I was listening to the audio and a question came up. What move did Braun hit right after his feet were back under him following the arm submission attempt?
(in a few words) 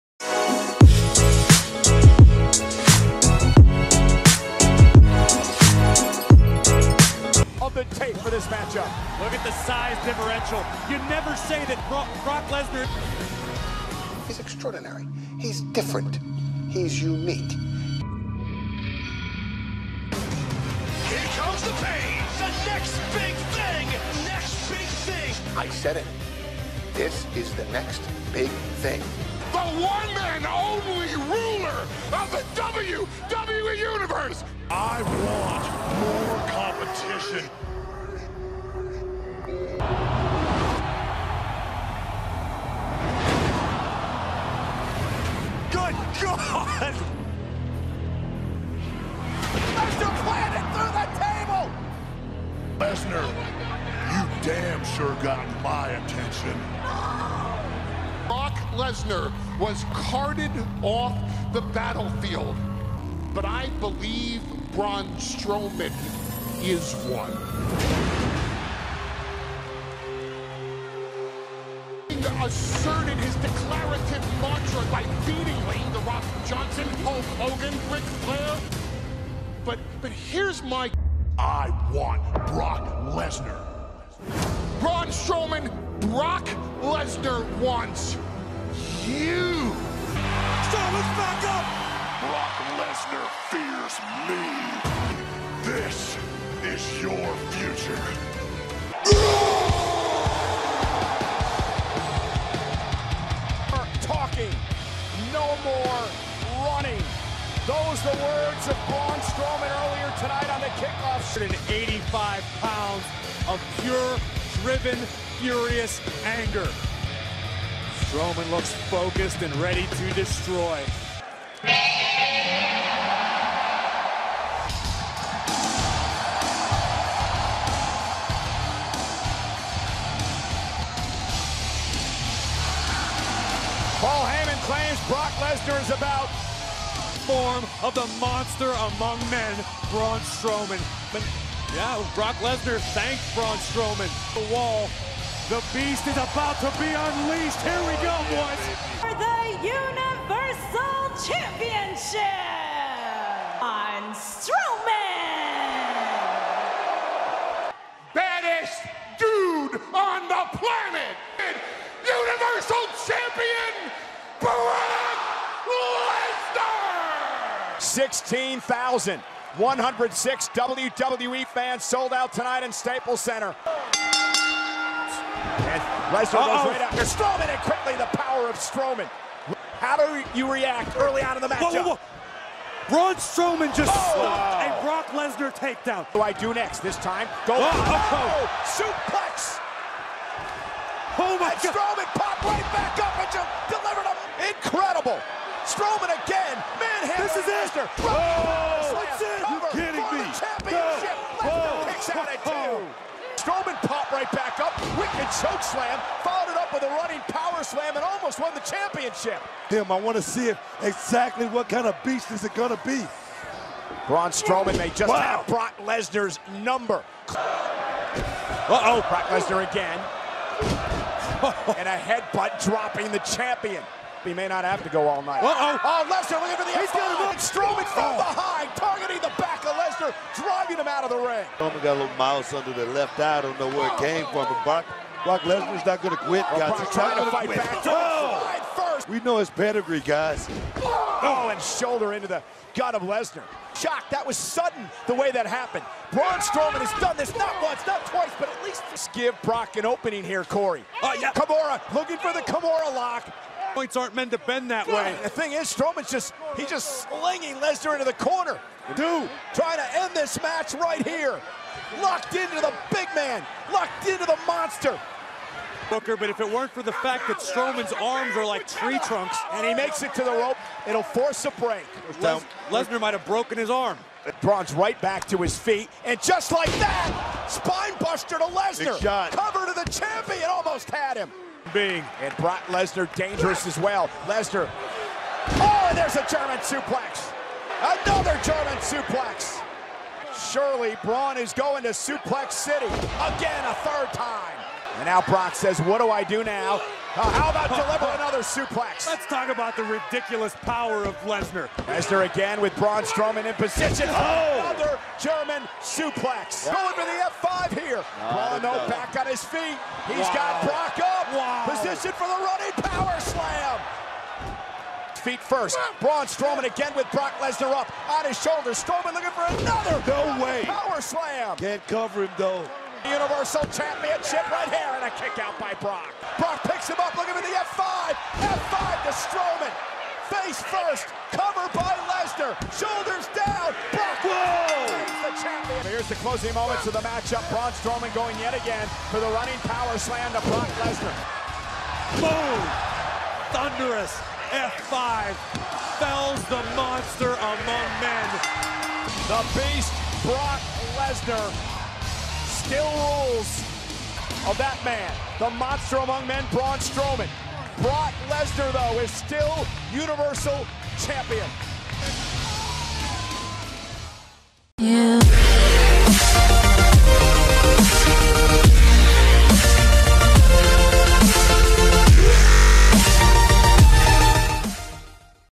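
Spinebuster.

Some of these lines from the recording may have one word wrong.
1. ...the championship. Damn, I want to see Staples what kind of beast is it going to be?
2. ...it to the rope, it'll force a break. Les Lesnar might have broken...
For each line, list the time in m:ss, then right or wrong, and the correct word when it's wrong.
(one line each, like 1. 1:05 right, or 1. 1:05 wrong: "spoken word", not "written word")
1. 3:28 wrong: "Exactly", not "Staples"
2. 4:30 right.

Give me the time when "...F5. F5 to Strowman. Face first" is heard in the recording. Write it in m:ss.
5:27.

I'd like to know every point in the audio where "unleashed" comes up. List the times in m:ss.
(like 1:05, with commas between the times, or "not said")
2:26.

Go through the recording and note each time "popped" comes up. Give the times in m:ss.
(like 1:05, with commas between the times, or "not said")
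3:12, 3:23.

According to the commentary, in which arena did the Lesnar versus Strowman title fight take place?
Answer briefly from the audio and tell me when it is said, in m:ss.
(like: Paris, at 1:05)
Staples Center, at 2:52.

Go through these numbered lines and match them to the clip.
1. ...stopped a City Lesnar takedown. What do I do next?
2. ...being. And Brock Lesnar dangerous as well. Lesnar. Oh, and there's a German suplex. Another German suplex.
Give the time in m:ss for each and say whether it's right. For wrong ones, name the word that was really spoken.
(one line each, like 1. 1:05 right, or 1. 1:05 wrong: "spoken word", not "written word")
1. 3:04 wrong: "Brock", not "City"
2. 4:41 right.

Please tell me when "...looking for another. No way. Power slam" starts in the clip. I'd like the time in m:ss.
5:19.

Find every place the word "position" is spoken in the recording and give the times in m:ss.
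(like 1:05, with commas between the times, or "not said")
5:03, 5:11.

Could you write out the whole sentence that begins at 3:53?
I don't know where it came from.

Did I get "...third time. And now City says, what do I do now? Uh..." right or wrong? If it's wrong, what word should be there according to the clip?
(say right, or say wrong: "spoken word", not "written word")
wrong: "Brock", not "City".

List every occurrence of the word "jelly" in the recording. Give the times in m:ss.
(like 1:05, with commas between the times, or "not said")
not said.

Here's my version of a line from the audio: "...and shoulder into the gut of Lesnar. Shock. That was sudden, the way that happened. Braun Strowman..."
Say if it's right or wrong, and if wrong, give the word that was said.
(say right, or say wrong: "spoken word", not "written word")
right.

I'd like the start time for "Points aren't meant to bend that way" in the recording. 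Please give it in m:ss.
4:13.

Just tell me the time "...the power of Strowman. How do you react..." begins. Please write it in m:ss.
2:57.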